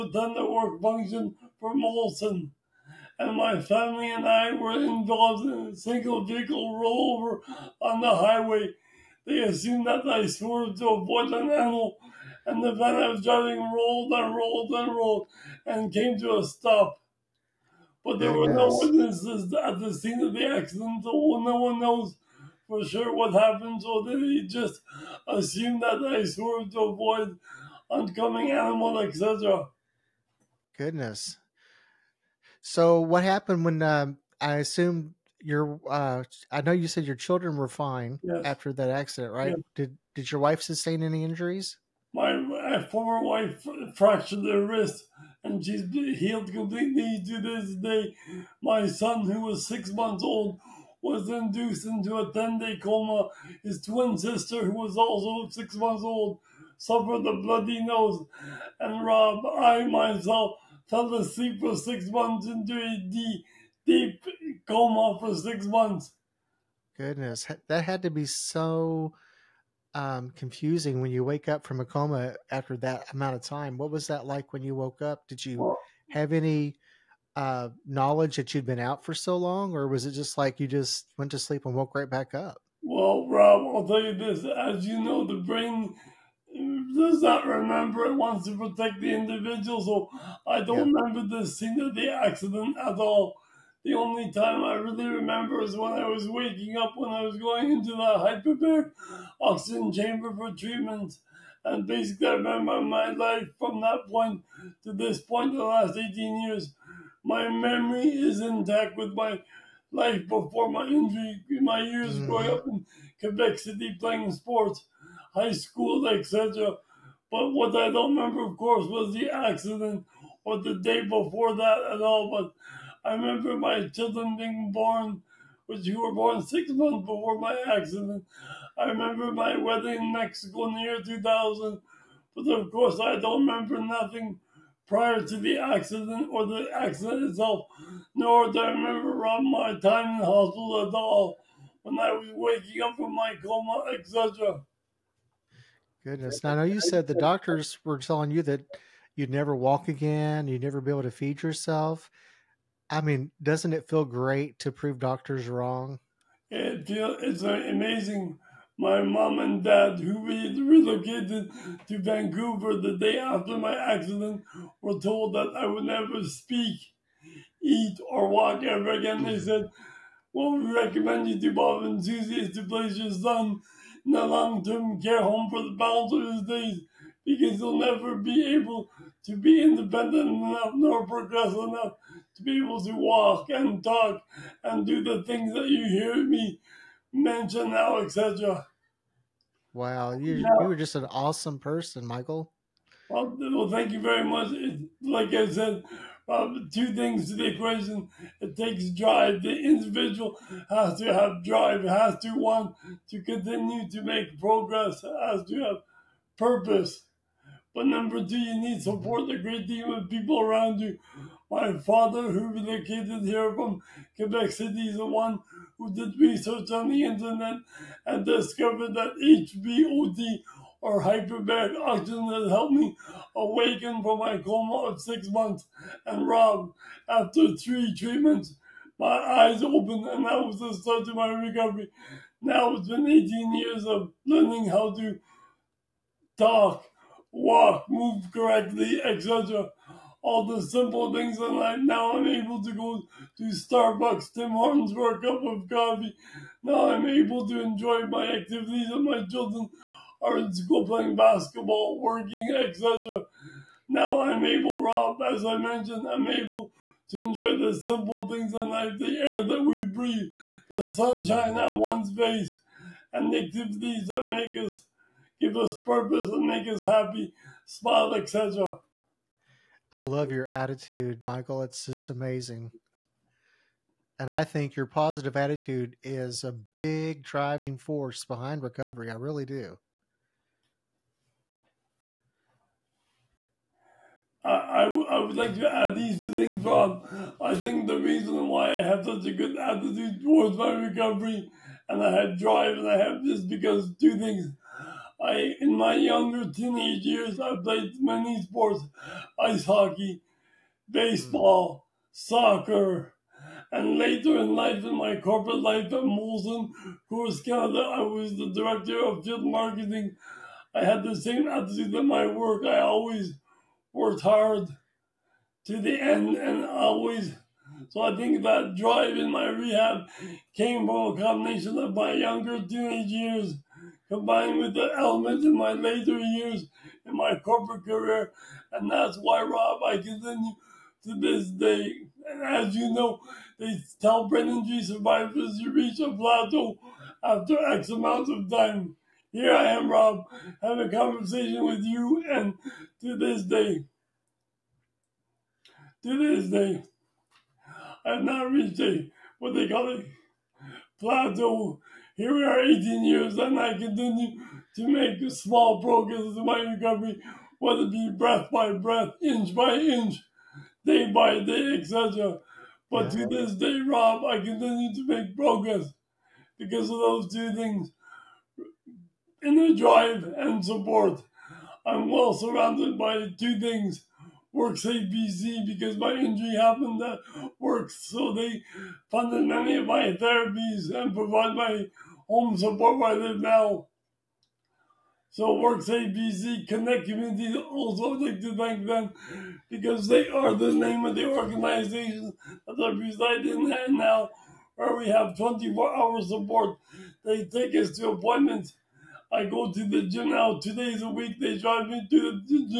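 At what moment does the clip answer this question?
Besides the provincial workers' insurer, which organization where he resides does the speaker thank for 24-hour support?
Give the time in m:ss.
6:26.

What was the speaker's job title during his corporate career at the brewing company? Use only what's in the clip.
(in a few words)
Director of field marketing.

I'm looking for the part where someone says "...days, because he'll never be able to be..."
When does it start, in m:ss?
2:56.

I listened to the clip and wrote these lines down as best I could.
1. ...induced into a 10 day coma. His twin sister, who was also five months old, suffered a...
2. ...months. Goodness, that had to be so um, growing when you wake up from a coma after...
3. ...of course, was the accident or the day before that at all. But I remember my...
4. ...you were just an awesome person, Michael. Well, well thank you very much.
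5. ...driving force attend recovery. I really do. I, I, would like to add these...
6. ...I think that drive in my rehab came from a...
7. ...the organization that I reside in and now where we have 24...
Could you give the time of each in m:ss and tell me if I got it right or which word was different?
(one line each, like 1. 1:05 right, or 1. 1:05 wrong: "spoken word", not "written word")
1. 0:51 wrong: "six", not "five"
2. 1:05 wrong: "confusing", not "growing"
3. 1:58 right
4. 3:10 right
5. 4:37 wrong: "behind", not "attend"
6. 5:18 right
7. 6:31 right.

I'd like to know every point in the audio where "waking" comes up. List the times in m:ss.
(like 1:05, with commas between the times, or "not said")
1:36, 2:22.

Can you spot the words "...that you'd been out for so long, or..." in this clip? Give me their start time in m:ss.
1:18.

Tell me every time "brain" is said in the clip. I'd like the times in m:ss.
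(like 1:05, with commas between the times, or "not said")
1:25, 5:34.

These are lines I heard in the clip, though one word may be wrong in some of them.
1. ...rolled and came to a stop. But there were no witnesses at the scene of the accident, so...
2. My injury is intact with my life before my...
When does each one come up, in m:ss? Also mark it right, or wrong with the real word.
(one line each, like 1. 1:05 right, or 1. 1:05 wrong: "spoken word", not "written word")
1. 0:14 right
2. 1:47 wrong: "memory", not "injury".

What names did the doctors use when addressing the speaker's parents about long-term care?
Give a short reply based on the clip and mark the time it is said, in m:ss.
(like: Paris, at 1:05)
Bob and Susie, at 2:51.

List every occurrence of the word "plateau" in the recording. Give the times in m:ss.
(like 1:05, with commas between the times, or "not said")
5:36, 5:50.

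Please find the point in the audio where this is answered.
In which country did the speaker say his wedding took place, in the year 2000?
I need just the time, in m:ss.
2:10.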